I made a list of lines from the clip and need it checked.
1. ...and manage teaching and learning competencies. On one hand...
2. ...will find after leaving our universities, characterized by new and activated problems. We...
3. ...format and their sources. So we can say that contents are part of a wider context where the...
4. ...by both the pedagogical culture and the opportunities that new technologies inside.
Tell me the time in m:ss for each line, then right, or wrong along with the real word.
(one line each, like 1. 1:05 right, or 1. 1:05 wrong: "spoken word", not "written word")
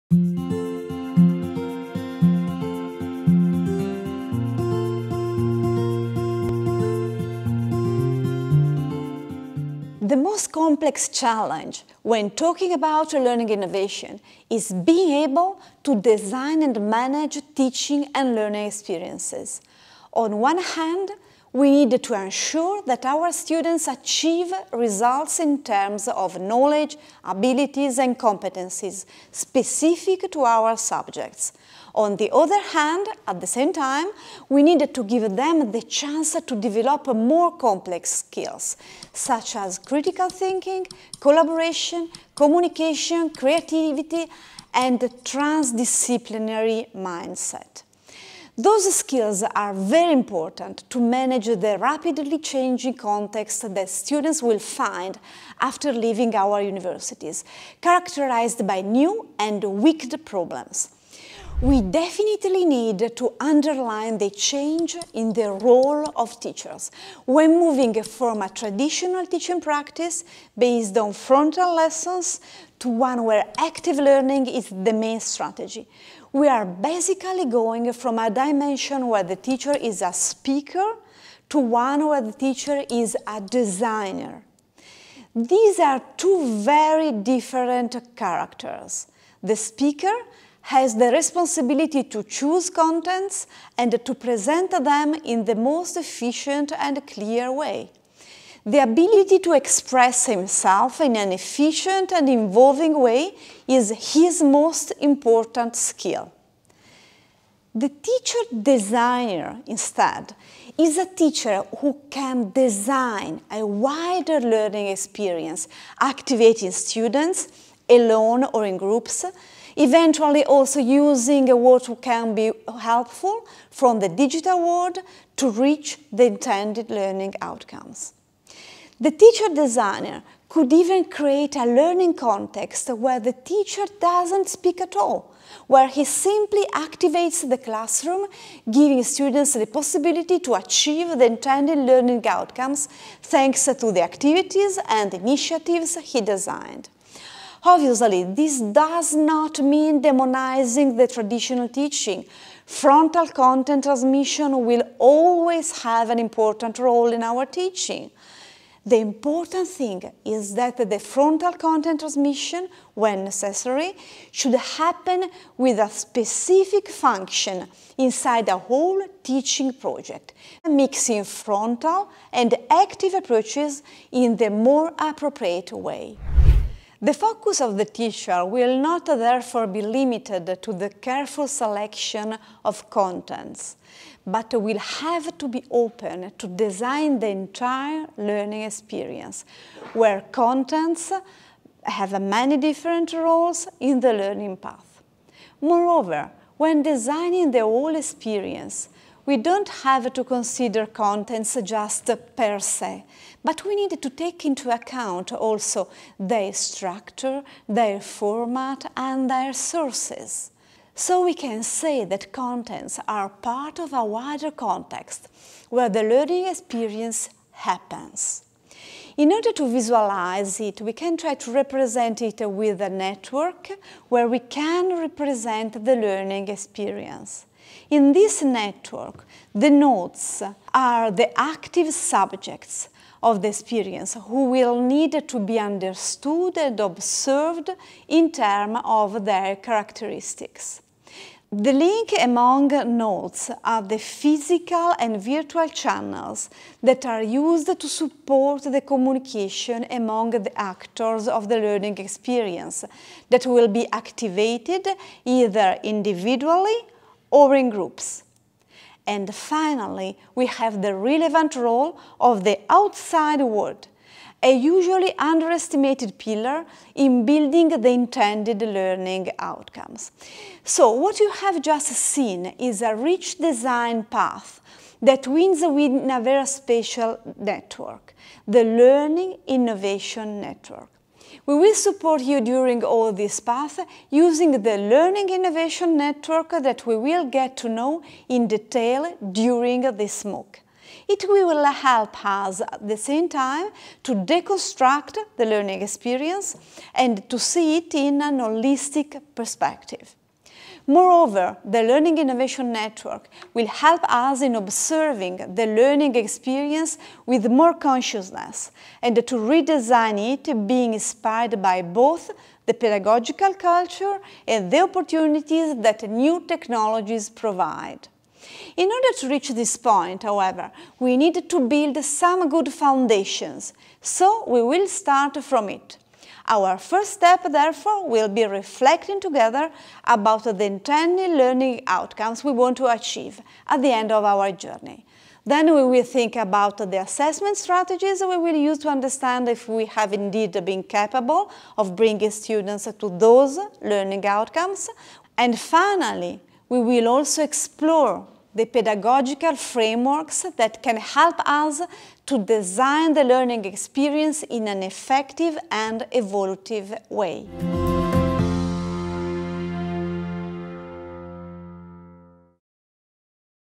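1. 0:16 wrong: "experiences", not "competencies"
2. 0:54 wrong: "wicked", not "activated"
3. 3:28 right
4. 5:11 wrong: "provide", not "inside".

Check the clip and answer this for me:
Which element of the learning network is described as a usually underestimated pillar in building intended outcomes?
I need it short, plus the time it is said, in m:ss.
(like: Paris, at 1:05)
the outside world, at 4:22.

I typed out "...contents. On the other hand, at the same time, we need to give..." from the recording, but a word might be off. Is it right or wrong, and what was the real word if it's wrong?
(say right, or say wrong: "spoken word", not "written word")
wrong: "subjects", not "contents".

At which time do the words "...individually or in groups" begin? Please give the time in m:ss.
4:15.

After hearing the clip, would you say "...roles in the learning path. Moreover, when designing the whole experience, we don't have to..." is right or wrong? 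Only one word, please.
right.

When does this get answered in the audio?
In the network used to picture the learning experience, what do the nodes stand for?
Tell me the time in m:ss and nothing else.
3:51.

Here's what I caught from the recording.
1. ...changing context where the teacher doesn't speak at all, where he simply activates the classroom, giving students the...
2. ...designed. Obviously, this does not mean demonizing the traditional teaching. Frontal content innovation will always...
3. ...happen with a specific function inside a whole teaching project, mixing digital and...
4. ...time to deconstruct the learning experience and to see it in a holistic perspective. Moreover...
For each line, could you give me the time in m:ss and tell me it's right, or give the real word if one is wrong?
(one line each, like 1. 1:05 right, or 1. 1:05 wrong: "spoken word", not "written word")
1. 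2:11 wrong: "learning", not "changing"
2. 2:26 wrong: "transmission", not "innovation"
3. 2:44 wrong: "frontal", not "digital"
4. 4:53 right.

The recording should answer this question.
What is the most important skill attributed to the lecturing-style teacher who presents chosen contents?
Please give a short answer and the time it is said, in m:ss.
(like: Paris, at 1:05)
express himself in an efficient and involving way, at 1:39.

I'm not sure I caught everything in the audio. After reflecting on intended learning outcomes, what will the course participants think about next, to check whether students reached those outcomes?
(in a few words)
assessment strategies.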